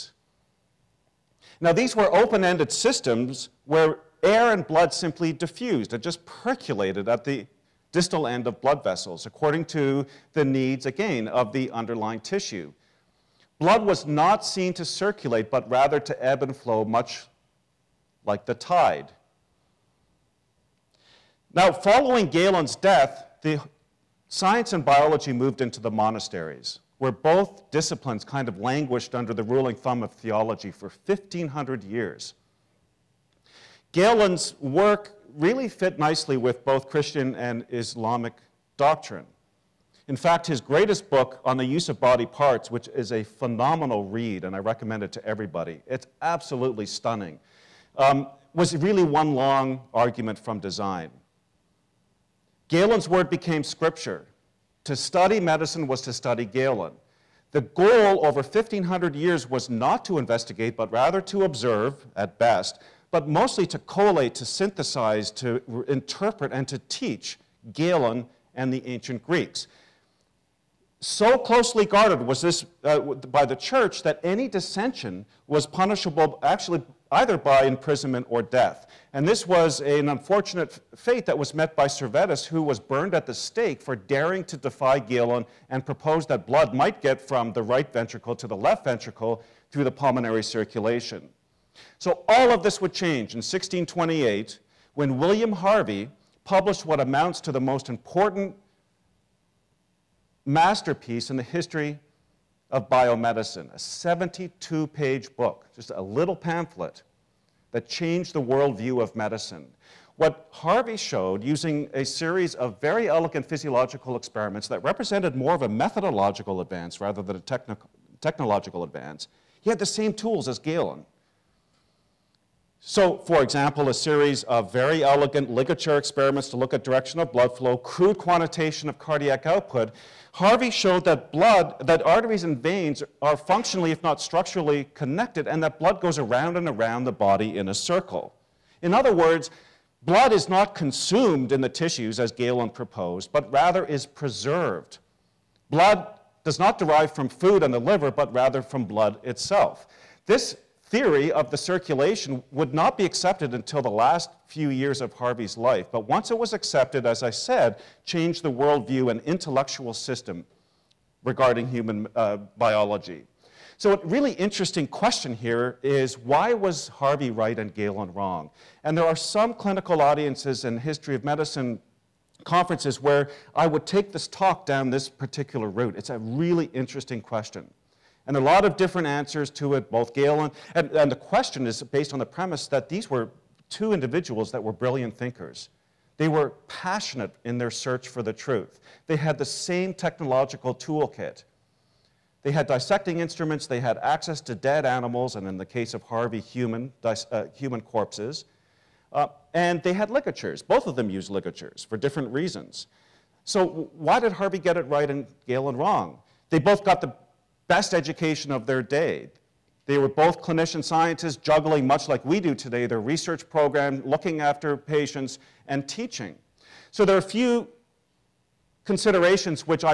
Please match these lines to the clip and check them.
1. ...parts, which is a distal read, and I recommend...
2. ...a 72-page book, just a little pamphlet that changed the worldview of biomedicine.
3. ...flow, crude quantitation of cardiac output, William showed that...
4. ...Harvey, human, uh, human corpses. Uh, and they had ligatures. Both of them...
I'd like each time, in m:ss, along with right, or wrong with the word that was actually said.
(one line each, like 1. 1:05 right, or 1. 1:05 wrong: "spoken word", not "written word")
1. 0:42 wrong: "phenomenal", not "distal"
2. 1:43 wrong: "medicine", not "biomedicine"
3. 2:07 wrong: "Harvey", not "William"
4. 3:16 right.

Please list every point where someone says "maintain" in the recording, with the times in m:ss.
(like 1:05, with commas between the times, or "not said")
not said.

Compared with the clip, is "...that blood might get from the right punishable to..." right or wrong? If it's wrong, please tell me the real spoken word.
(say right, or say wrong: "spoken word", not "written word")
wrong: "ventricle", not "punishable".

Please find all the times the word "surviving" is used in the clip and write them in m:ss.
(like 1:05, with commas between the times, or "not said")
not said.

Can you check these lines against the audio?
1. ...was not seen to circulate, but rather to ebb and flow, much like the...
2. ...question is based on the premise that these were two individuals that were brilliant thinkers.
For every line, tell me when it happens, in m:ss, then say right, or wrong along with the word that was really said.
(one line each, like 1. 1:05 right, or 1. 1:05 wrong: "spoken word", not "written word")
1. 0:13 right
2. 3:01 right.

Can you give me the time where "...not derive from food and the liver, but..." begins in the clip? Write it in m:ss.
2:26.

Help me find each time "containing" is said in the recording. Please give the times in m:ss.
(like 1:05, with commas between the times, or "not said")
not said.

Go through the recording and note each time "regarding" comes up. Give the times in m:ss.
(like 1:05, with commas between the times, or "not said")
2:41.